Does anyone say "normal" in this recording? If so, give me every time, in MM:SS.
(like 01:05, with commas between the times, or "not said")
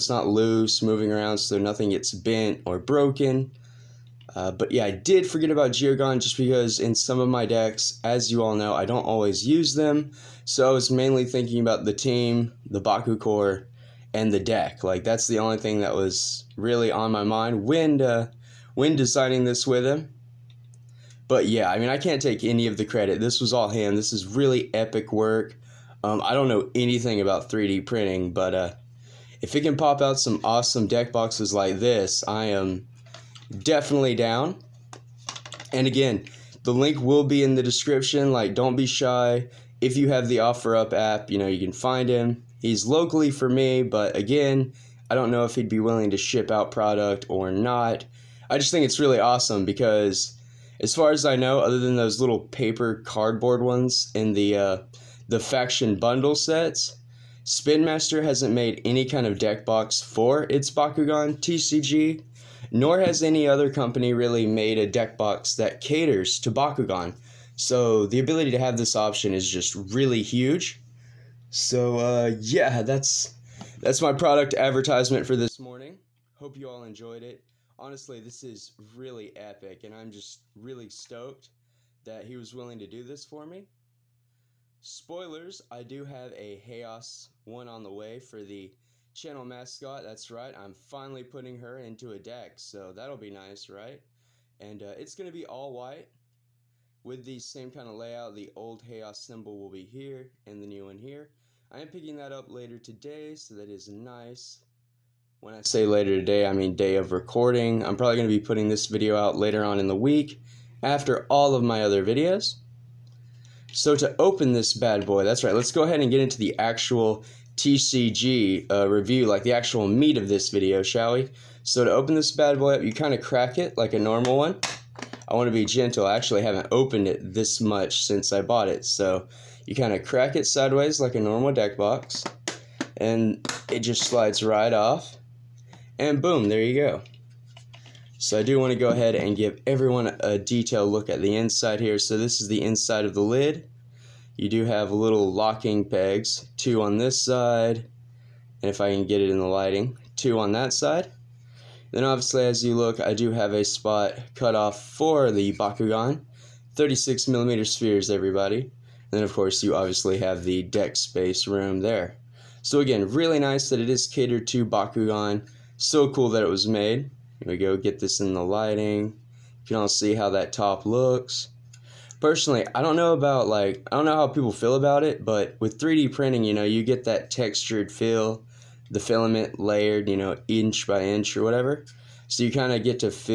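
02:03, 02:11.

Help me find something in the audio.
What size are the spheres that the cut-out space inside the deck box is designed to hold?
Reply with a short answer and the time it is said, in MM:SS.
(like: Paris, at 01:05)
36 millimeters, at 02:36.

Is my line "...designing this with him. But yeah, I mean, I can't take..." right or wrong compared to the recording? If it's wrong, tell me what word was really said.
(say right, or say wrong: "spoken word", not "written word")
right.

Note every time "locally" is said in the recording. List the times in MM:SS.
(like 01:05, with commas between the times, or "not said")
00:42.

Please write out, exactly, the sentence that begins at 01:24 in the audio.
Spoilers, I do have a Chaos one on the way for the channel mascot.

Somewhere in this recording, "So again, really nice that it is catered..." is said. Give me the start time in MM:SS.
02:42.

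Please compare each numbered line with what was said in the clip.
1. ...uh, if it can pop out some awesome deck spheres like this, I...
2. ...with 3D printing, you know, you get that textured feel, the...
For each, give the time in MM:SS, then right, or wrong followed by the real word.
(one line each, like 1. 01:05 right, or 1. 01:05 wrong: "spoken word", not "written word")
1. 00:28 wrong: "boxes", not "spheres"
2. 02:55 right.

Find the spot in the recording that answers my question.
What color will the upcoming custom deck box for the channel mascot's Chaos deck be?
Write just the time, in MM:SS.
01:35.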